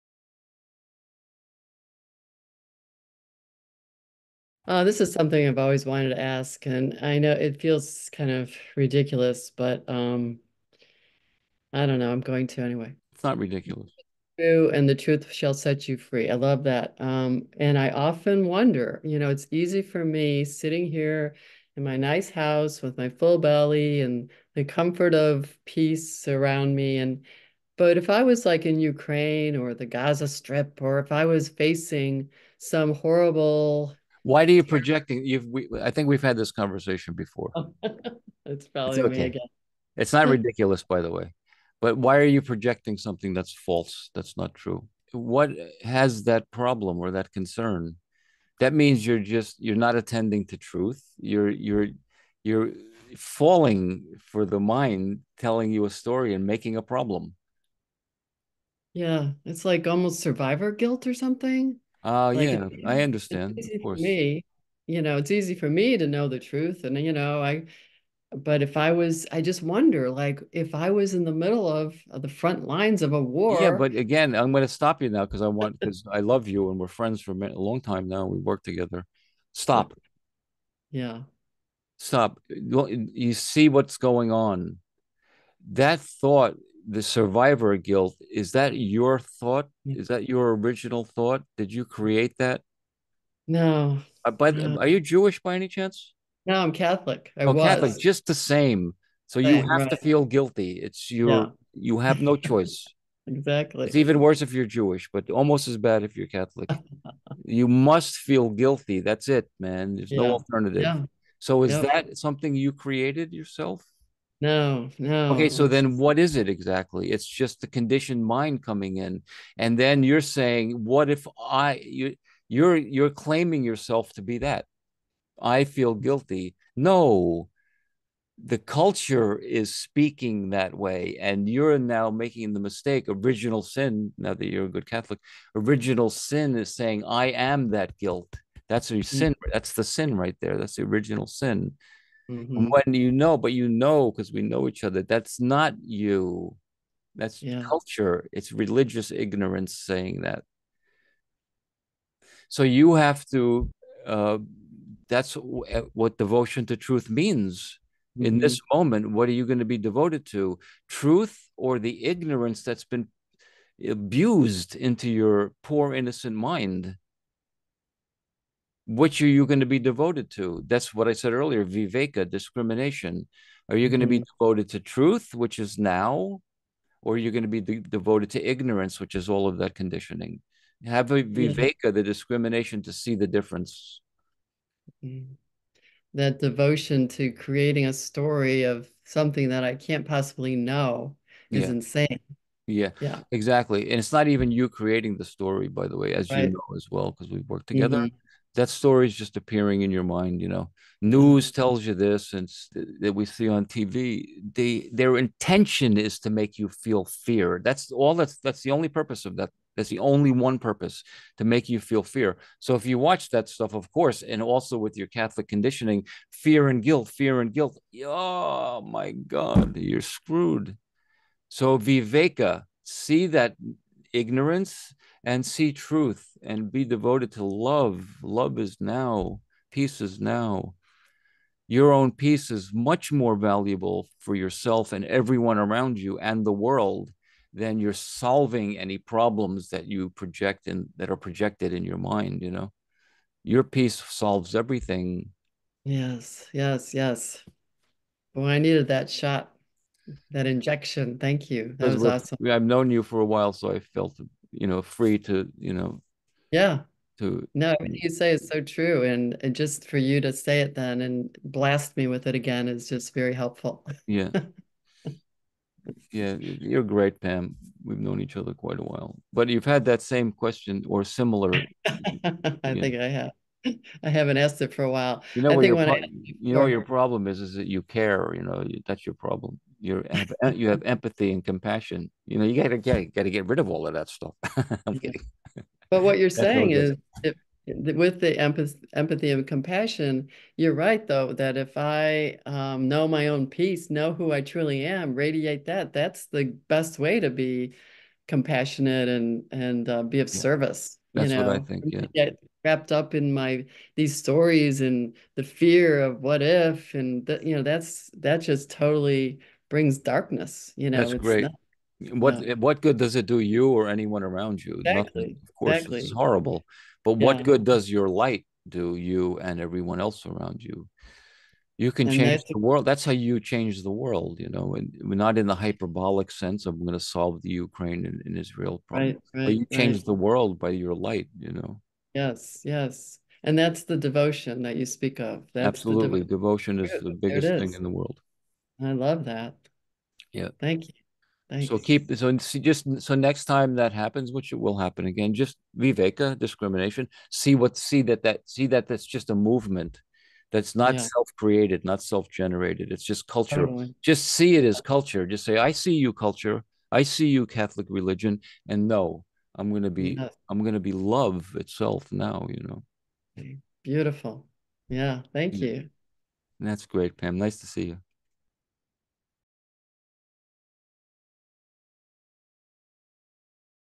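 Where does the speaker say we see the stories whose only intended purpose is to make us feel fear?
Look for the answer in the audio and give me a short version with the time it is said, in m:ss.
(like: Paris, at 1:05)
TV, at 3:23.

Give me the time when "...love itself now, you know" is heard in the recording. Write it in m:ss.
6:00.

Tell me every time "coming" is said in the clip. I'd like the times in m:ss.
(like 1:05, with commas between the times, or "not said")
1:58.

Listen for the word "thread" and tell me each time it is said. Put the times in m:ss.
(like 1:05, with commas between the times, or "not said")
not said.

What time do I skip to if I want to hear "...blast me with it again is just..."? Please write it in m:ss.
4:21.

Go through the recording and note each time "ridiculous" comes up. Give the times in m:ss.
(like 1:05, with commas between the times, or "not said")
0:08, 0:13, 0:40.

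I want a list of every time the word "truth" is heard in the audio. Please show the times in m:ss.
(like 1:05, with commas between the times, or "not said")
0:14, 0:50, 1:06, 2:36, 2:40, 2:54, 3:45.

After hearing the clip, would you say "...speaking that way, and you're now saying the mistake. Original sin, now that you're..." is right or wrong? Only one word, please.
wrong.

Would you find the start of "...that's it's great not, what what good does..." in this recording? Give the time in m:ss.
5:10.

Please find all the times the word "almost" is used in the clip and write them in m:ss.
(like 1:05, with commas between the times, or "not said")
0:59, 1:45.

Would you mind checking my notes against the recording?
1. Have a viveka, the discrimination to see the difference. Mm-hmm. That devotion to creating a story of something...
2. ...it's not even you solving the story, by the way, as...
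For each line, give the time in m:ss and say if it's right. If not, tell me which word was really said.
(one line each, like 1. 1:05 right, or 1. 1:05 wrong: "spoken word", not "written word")
1. 3:00 right
2. 3:13 wrong: "creating", not "solving".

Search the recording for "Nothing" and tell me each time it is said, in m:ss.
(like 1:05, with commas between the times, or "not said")
5:15.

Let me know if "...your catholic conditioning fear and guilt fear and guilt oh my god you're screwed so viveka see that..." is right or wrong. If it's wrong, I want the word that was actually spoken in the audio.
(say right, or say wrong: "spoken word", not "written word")
right.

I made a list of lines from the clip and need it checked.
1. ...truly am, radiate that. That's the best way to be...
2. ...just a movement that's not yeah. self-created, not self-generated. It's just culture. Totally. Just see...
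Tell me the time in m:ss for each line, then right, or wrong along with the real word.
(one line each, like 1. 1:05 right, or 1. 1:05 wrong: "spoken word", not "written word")
1. 4:54 right
2. 5:49 right.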